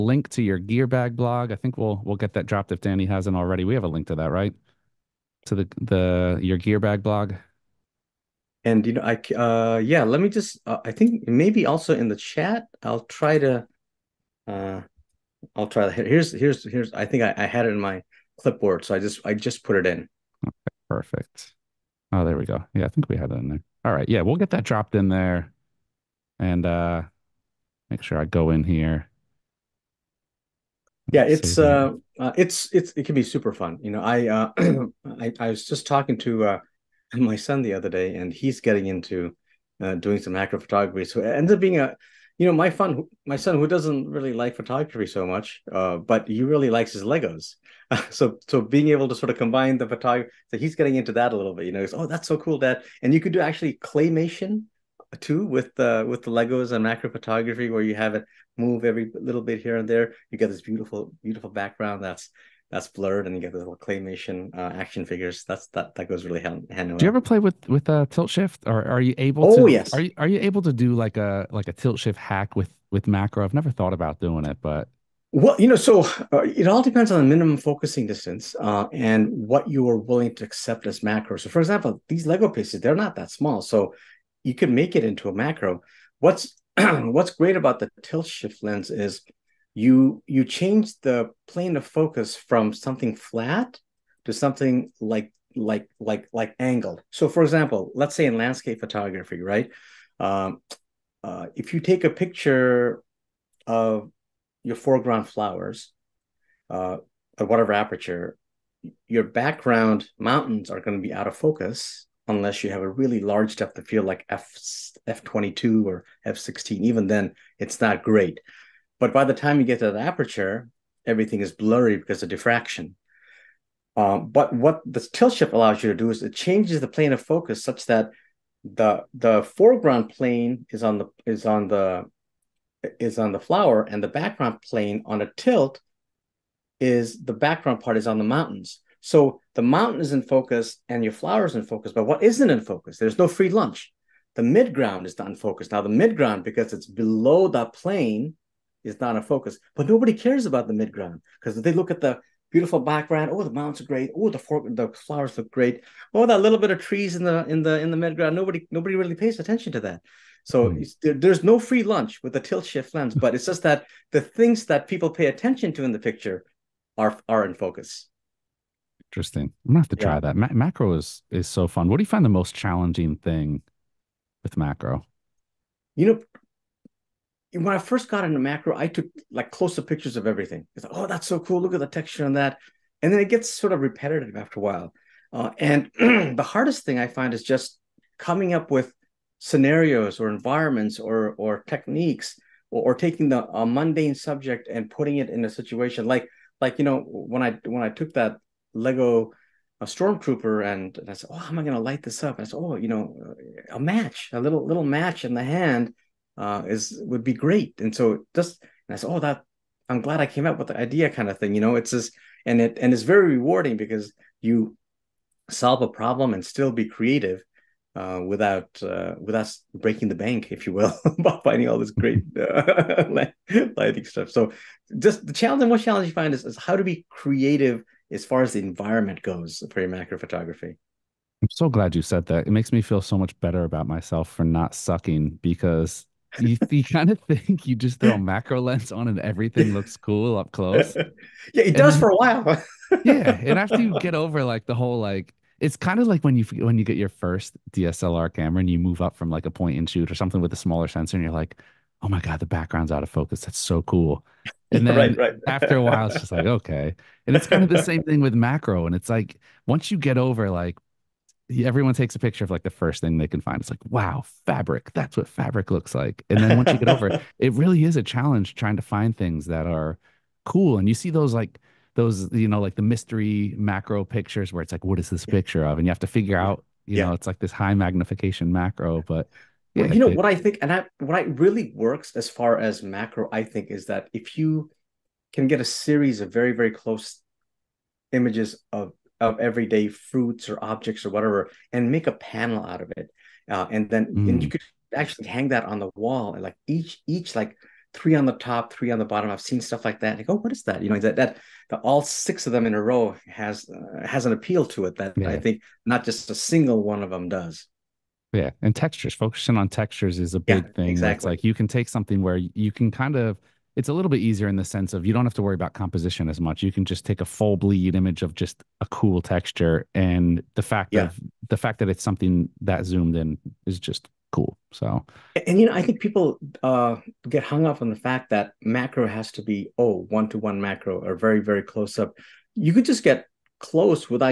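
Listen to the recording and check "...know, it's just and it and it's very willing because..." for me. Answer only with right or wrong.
wrong.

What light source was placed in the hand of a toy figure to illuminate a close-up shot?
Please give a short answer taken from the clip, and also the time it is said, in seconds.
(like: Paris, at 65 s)
a match, at 203 s.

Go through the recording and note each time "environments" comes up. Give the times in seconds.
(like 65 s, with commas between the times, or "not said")
190 s, 228 s.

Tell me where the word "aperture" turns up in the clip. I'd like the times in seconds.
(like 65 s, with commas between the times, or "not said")
107 s, 119 s.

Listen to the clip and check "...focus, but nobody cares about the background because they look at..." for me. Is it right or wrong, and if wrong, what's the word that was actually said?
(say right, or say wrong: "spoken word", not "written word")
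wrong: "midground", not "background".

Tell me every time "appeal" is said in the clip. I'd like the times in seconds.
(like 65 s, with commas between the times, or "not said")
304 s.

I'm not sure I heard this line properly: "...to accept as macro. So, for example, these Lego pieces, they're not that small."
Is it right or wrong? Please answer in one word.
right.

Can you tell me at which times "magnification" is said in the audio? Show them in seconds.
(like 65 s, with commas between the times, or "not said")
277 s.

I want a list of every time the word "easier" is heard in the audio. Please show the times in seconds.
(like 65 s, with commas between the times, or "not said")
314 s.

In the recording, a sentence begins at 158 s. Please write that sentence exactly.
Nobody nobody really pays attention to that.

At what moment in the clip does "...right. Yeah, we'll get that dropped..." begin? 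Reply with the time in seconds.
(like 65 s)
23 s.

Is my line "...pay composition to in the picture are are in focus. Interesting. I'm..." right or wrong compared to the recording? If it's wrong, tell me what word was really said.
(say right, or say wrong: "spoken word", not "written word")
wrong: "attention", not "composition".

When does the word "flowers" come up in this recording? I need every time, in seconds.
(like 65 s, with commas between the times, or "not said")
105 s, 133 s, 141 s, 154 s.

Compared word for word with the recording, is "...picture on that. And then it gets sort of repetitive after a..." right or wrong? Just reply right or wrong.
wrong.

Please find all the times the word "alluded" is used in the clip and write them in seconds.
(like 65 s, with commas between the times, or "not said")
not said.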